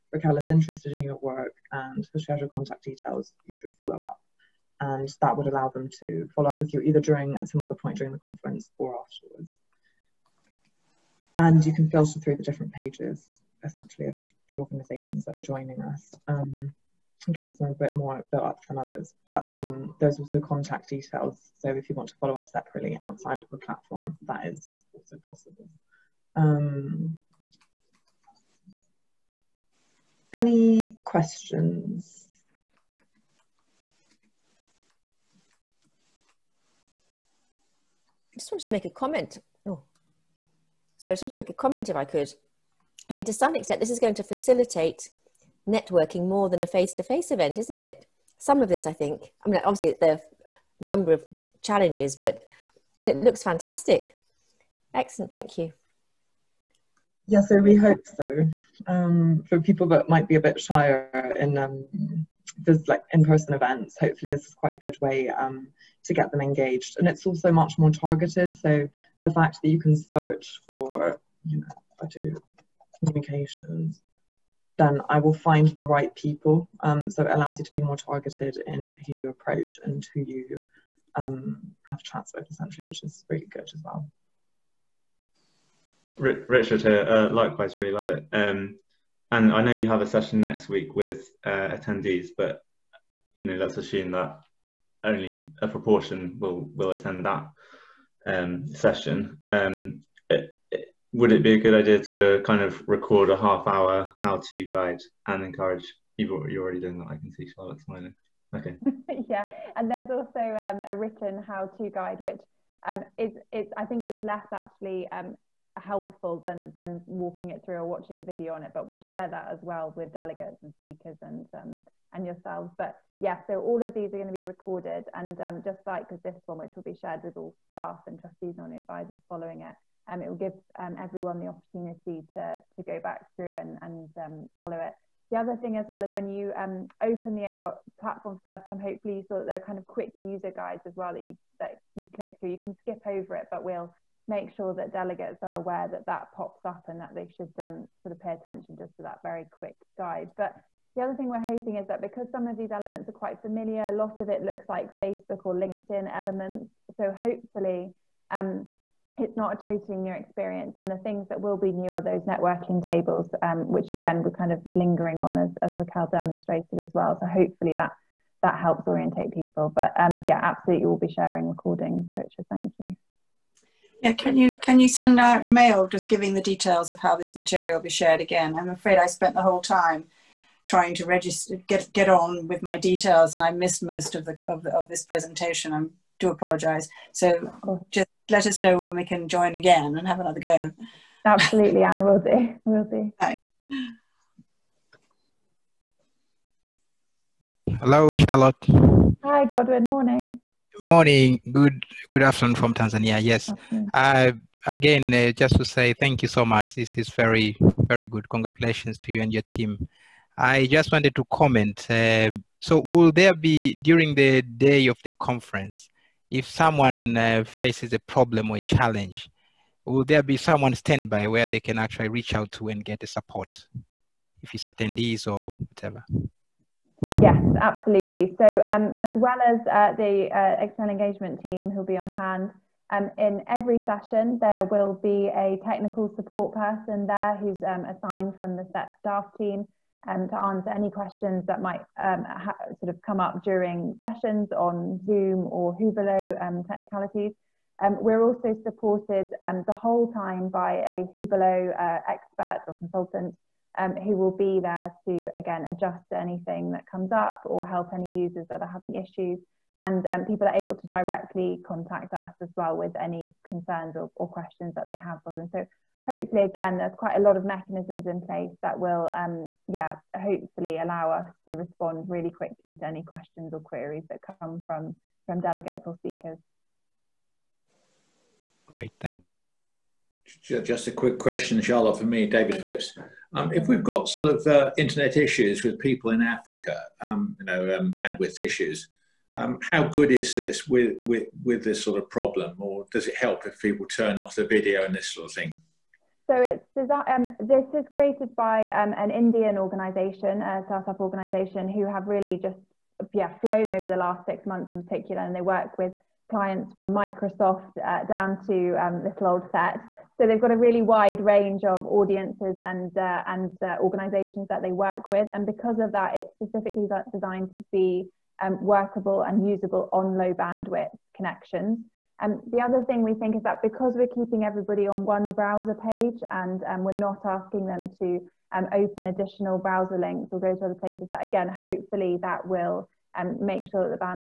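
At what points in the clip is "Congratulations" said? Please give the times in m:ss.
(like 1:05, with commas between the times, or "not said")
3:28.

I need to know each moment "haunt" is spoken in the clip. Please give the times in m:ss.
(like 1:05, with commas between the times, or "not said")
not said.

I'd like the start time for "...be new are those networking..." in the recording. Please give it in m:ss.
2:41.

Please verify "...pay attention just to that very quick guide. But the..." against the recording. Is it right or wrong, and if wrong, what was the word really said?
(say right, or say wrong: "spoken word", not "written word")
right.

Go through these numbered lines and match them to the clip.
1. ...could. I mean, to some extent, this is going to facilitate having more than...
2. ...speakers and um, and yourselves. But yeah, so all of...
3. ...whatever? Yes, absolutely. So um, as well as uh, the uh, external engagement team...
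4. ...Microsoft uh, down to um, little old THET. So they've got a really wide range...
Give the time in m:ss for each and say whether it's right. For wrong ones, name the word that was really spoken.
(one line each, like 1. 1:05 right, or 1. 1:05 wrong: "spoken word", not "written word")
1. 0:42 wrong: "networking", not "having"
2. 2:00 right
3. 3:45 right
4. 5:06 right.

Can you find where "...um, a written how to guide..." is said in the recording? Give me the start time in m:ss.
1:50.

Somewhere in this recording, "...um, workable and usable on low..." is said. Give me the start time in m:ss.
5:18.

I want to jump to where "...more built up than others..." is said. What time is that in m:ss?
0:17.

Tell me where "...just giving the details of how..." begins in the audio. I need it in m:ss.
2:55.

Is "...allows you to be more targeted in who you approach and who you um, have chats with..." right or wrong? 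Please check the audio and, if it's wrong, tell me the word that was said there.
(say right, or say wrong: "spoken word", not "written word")
right.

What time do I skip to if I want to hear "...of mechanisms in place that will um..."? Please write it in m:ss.
4:27.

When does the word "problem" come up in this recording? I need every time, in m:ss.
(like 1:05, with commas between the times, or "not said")
3:37, 4:52.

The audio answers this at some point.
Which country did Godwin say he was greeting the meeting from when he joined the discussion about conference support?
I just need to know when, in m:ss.
3:22.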